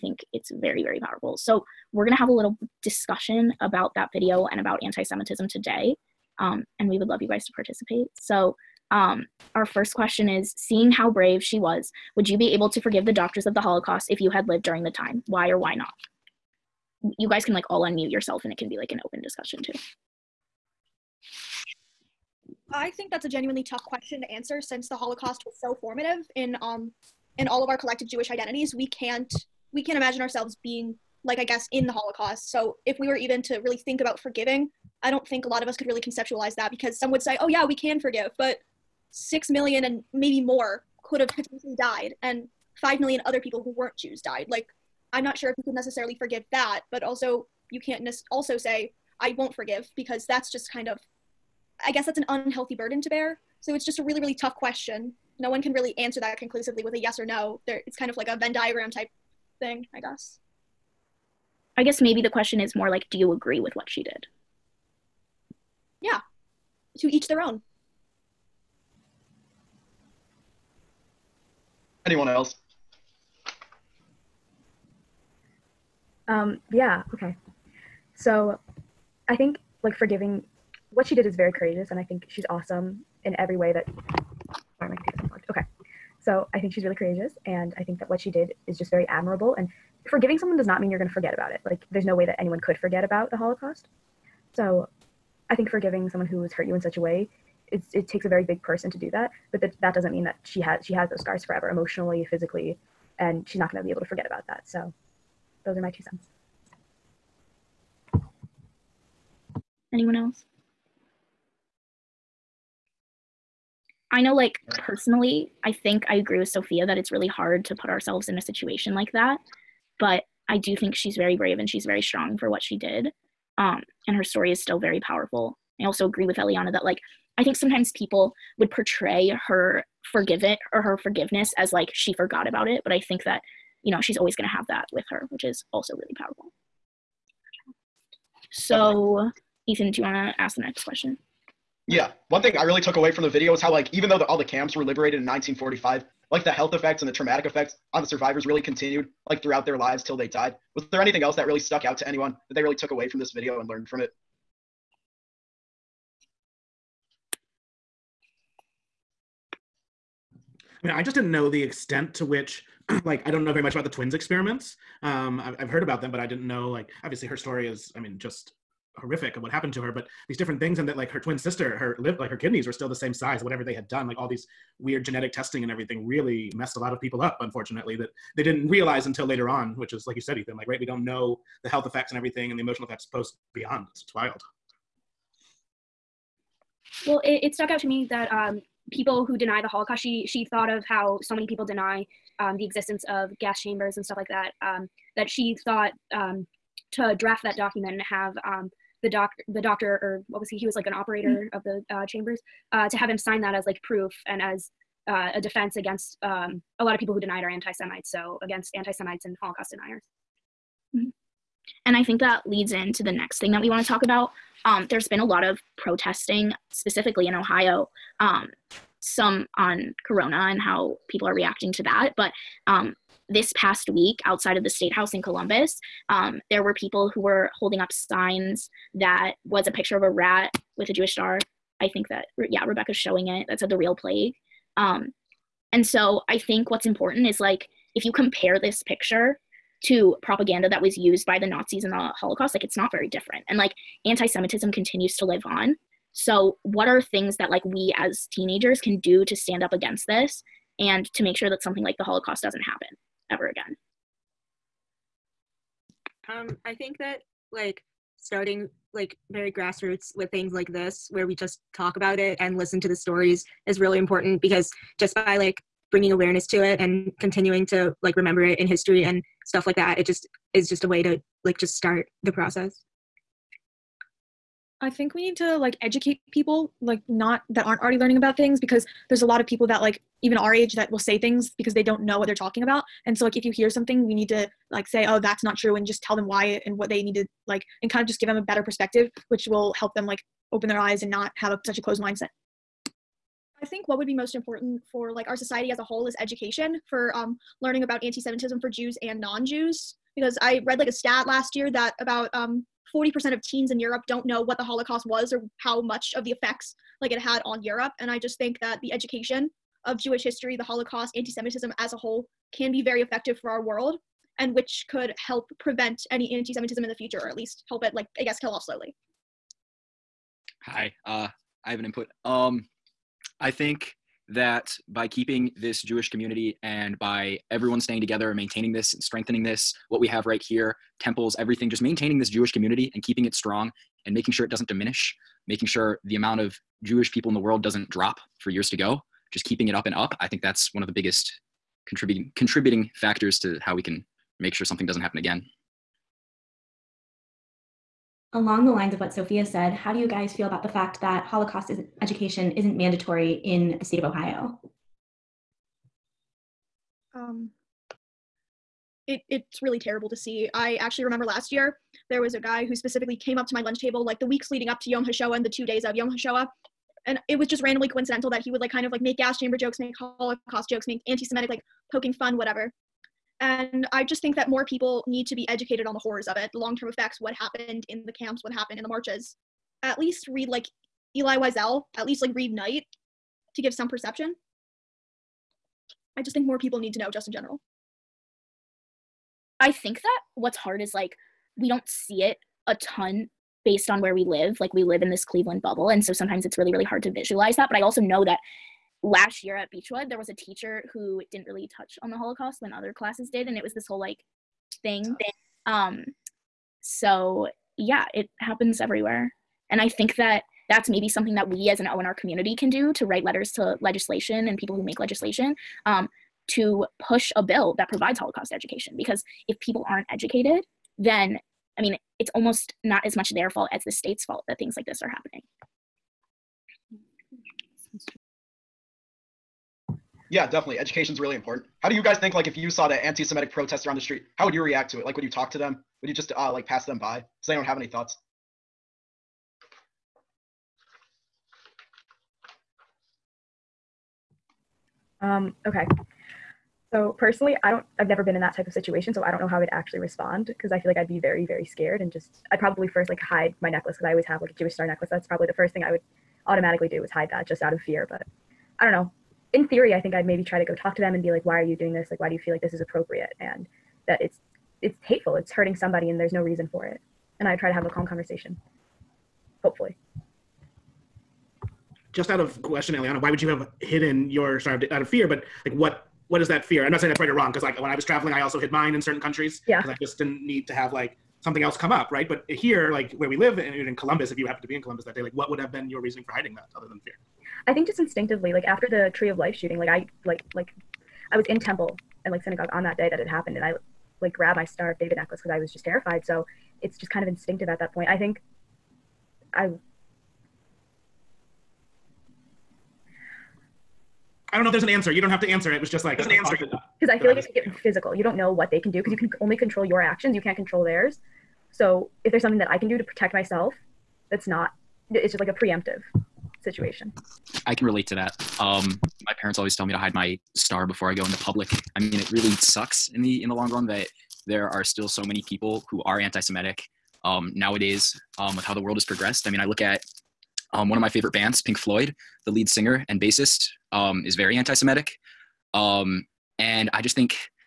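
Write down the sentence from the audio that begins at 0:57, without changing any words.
There, it's kind of like a Venn diagram type thing, I guess.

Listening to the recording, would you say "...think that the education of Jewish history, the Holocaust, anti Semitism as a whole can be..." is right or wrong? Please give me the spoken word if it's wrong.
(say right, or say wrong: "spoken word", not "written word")
right.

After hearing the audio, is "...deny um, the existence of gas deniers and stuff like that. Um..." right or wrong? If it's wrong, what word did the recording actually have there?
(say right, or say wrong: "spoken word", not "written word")
wrong: "chambers", not "deniers".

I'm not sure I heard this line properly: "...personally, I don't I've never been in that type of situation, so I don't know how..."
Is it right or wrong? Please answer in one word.
right.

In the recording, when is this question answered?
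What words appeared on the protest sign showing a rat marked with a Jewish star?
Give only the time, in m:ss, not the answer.
3:53.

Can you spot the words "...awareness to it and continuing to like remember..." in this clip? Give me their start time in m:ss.
4:26.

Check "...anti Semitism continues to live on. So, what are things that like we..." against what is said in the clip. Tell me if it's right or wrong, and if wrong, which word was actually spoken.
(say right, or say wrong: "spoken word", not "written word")
right.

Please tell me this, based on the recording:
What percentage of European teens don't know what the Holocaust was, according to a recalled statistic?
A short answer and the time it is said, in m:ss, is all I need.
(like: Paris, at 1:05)
40%, at 5:02.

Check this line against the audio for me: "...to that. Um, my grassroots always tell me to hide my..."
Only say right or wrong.
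wrong.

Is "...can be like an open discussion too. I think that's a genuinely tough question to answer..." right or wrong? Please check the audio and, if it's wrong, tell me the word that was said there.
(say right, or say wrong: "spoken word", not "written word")
right.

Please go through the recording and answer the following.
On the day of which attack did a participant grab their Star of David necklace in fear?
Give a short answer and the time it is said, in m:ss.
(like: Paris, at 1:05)
Tree of Life shooting, at 8:09.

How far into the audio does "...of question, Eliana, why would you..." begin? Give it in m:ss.
7:52.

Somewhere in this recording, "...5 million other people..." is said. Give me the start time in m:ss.
0:42.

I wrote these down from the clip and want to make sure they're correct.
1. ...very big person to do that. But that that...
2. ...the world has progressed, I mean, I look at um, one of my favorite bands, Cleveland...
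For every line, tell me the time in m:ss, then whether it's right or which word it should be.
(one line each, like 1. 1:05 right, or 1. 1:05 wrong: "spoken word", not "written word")
1. 1:38 right
2. 8:48 wrong: "Pink", not "Cleveland".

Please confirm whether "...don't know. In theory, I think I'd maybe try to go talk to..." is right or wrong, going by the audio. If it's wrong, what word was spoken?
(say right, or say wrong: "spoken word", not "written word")
right.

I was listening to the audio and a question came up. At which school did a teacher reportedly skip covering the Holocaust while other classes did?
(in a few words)
Beechwood.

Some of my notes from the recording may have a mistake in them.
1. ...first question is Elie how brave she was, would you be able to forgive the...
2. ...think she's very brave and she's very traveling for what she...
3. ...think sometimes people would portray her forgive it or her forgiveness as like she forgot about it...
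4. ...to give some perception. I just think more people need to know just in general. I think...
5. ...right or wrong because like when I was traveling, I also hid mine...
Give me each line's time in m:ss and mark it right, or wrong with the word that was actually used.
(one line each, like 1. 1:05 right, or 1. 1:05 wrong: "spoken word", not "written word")
1. 0:09 wrong: "Seeing", not "Elie"
2. 2:00 wrong: "strong", not "traveling"
3. 2:07 right
4. 6:23 right
5. 7:57 right.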